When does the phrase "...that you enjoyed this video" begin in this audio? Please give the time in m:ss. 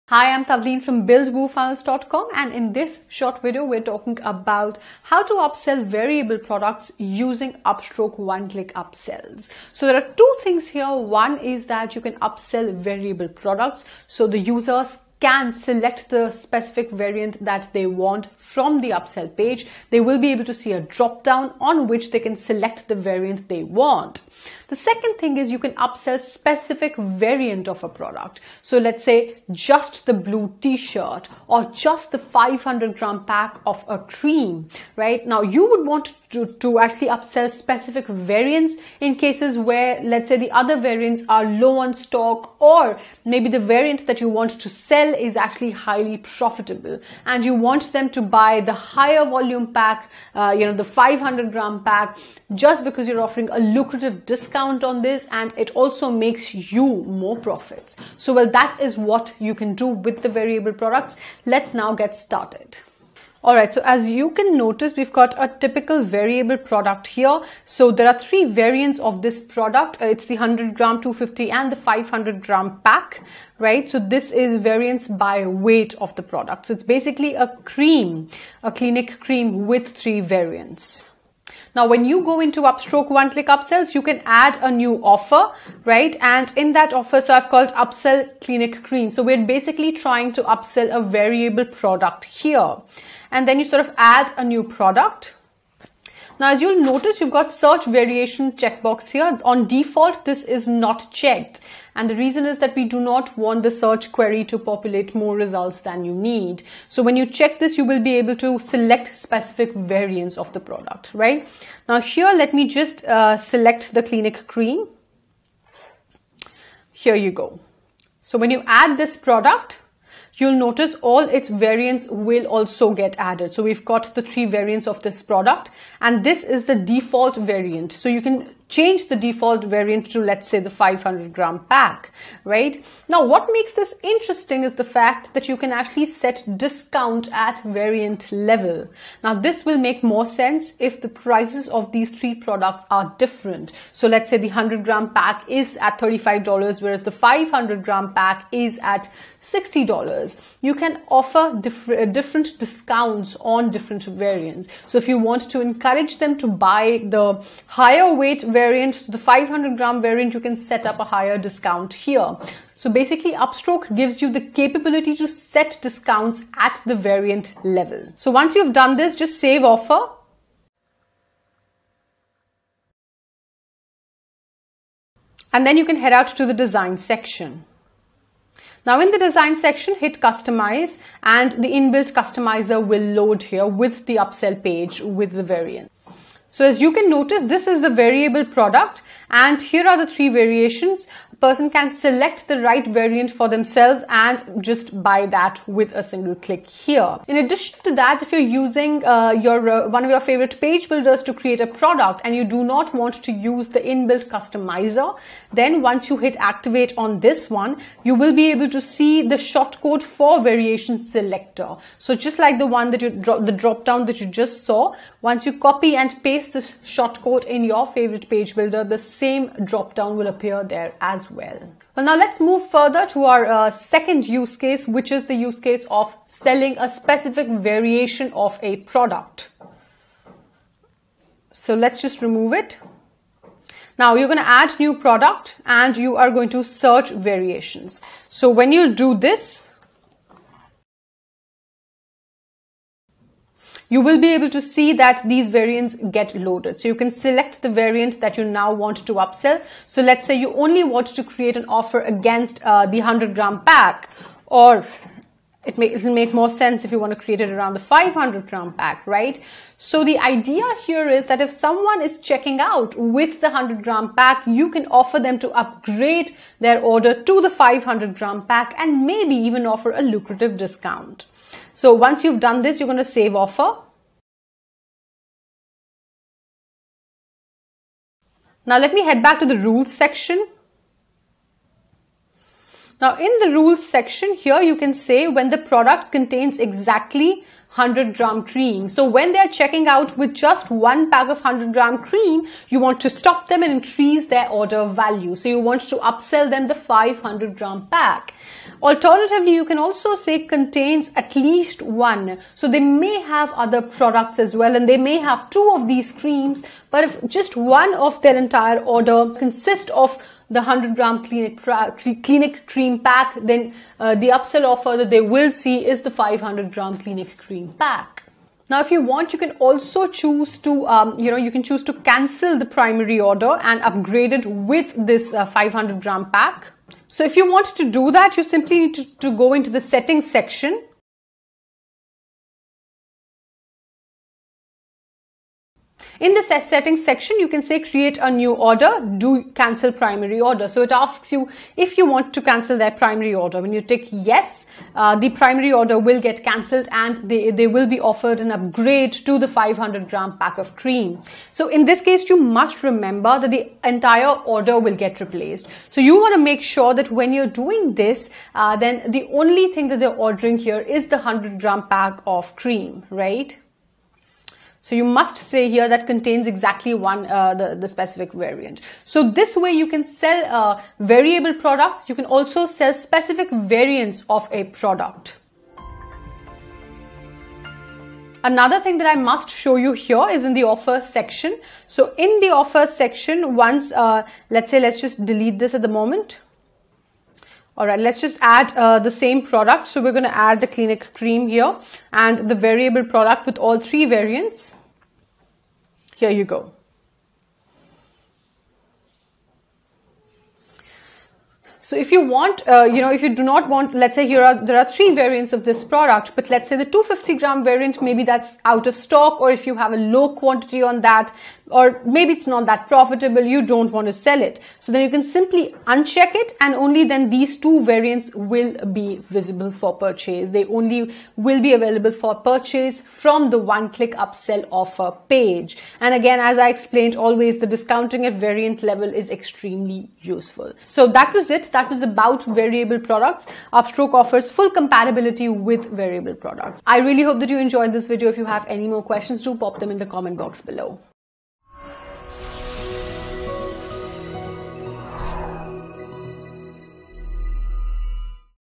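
7:17.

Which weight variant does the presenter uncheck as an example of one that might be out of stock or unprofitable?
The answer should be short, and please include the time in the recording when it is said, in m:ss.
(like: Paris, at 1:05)
250 gram, at 6:46.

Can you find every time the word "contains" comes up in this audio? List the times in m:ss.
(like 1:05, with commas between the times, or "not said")
4:46, 5:00, 6:06.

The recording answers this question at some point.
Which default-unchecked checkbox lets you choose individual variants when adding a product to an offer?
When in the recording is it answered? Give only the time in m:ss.
1:37.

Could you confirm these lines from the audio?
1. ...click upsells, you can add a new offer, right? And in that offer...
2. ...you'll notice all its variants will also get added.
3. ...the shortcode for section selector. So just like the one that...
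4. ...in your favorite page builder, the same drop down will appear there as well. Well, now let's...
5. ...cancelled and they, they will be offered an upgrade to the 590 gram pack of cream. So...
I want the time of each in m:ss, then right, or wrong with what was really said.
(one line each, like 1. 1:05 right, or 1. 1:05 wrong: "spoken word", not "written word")
1. 1:23 right
2. 2:00 right
3. 3:29 wrong: "variation", not "section"
4. 3:37 right
5. 5:46 wrong: "500", not "590".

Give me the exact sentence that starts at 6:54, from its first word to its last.
So then you can simply uncheck it and only then these two variants will be visible for purchase.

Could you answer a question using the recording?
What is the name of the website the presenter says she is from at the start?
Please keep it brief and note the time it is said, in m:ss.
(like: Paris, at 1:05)
buildwoofunnels.com, at 0:01.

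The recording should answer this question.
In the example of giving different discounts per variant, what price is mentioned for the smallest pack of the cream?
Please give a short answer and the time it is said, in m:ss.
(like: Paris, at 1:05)
$35, at 2:25.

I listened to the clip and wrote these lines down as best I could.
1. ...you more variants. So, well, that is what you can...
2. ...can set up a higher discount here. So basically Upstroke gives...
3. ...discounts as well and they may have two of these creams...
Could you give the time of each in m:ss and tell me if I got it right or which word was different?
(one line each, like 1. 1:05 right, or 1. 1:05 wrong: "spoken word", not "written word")
1. 0:56 wrong: "profits", not "variants"
2. 2:40 right
3. 5:03 wrong: "products", not "discounts".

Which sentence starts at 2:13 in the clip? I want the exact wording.
Now, what makes this interesting is the fact that you can actually set discount at variant level.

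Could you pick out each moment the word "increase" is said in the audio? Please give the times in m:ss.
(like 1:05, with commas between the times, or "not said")
4:53.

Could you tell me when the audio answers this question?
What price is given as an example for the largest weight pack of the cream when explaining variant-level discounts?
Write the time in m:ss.
2:29.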